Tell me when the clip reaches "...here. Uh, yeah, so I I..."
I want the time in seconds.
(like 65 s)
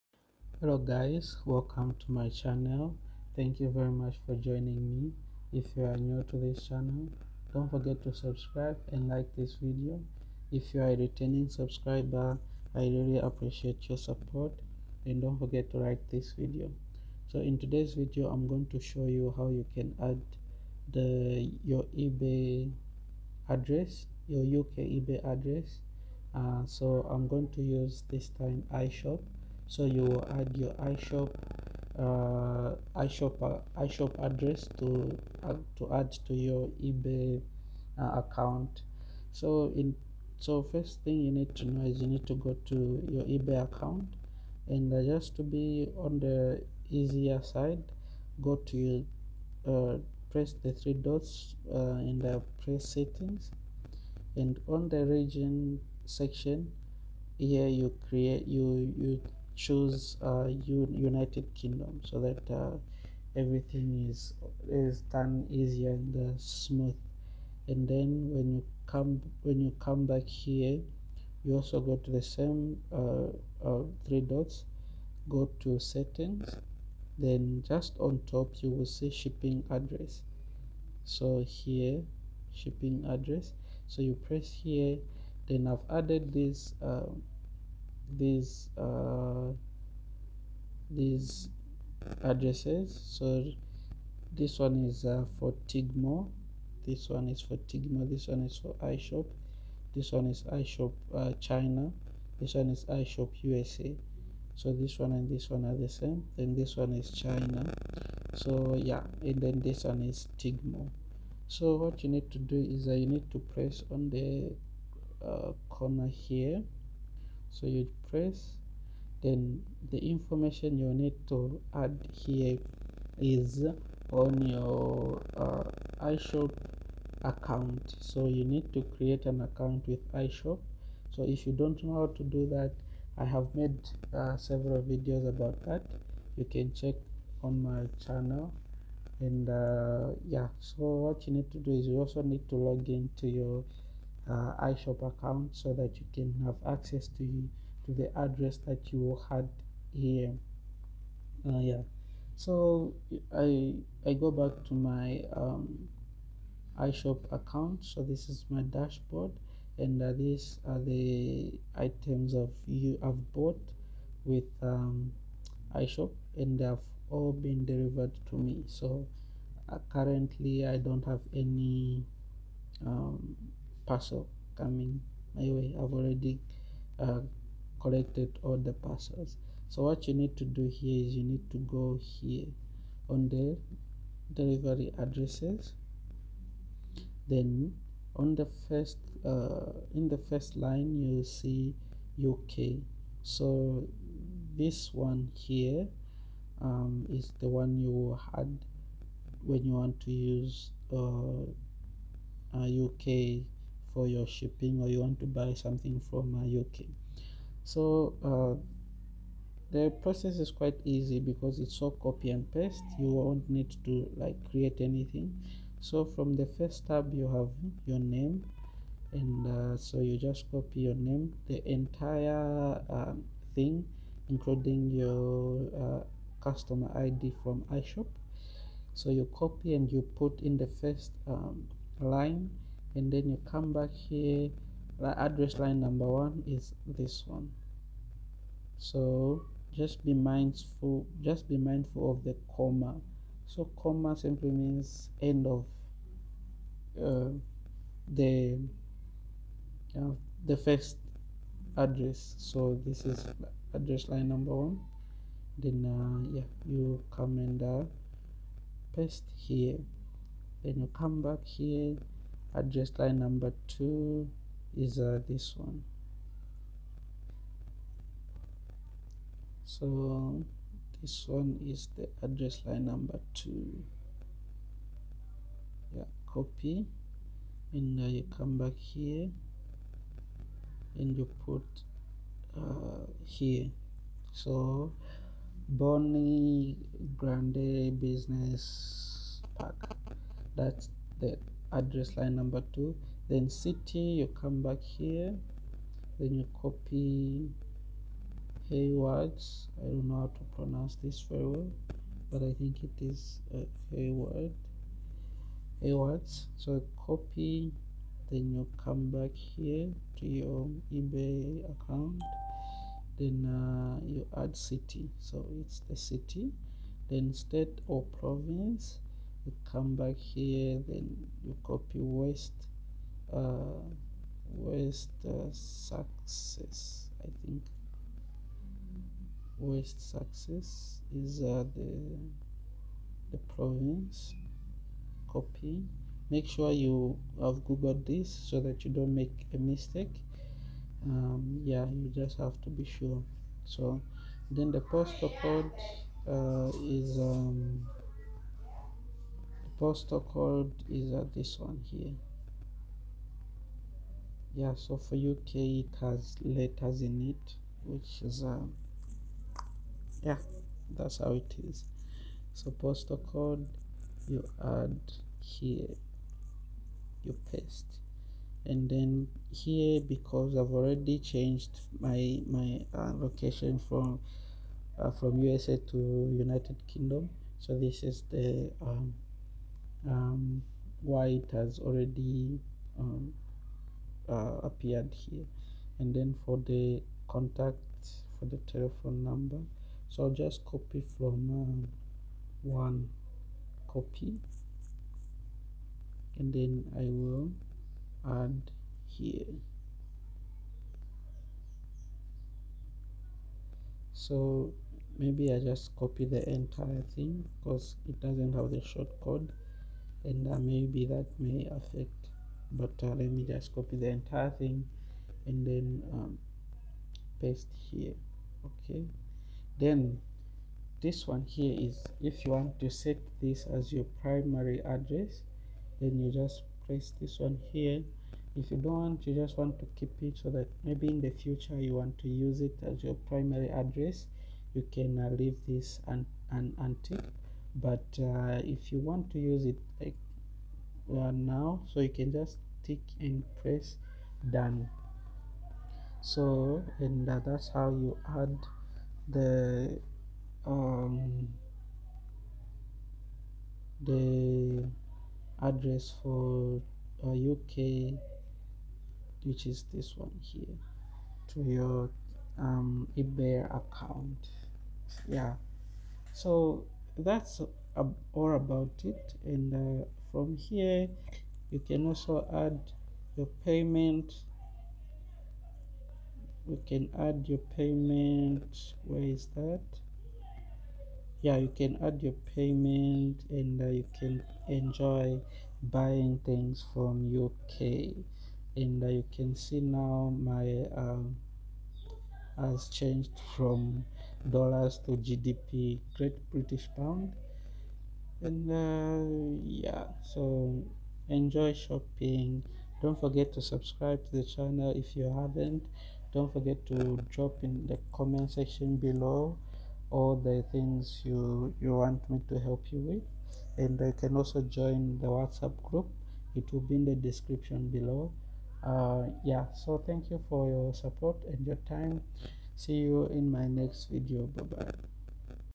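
149 s.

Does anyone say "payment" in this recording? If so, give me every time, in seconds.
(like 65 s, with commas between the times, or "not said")
473 s, 477 s, 482 s.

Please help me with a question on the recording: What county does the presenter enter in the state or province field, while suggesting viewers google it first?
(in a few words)
West Sussex.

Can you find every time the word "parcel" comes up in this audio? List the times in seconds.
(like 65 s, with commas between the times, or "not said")
173 s, 178 s.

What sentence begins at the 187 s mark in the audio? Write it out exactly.
Then on the first uh, in the first line you see UK.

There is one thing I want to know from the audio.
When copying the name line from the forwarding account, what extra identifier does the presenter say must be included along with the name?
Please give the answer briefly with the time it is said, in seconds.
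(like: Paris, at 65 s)
customer ID, at 226 s.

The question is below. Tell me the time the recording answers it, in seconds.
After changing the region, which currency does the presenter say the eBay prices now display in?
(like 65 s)
495 s.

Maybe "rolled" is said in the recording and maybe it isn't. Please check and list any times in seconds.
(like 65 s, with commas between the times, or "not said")
not said.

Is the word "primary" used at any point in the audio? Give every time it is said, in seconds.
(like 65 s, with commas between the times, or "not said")
424 s, 433 s.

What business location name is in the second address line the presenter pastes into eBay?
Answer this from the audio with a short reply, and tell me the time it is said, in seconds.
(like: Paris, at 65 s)
Bonnie Grande business pack, at 285 s.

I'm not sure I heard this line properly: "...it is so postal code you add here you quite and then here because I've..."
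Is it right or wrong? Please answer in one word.
wrong.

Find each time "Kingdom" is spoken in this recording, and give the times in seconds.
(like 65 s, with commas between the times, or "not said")
61 s, 376 s.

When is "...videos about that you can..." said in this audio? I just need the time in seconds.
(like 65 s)
134 s.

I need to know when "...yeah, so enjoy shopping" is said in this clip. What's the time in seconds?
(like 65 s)
499 s.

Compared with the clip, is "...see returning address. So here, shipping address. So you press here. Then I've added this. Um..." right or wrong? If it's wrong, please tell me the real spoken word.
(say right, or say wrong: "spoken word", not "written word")
wrong: "shipping", not "returning".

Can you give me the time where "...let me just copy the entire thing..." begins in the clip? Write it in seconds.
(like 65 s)
413 s.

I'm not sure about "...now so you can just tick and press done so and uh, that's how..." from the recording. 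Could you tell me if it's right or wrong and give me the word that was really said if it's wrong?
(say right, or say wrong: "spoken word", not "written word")
right.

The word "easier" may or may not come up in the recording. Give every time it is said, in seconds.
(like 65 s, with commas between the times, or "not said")
46 s, 65 s.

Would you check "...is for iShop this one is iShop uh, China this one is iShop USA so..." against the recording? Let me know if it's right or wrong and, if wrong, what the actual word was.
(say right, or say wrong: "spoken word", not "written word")
right.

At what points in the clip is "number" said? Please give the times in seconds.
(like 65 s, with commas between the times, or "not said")
235 s, 254 s, 263 s, 272 s, 292 s, 389 s.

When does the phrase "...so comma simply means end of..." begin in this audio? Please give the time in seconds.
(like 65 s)
243 s.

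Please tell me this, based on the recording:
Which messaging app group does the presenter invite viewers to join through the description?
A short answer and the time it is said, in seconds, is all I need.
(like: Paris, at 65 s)
WhatsApp, at 515 s.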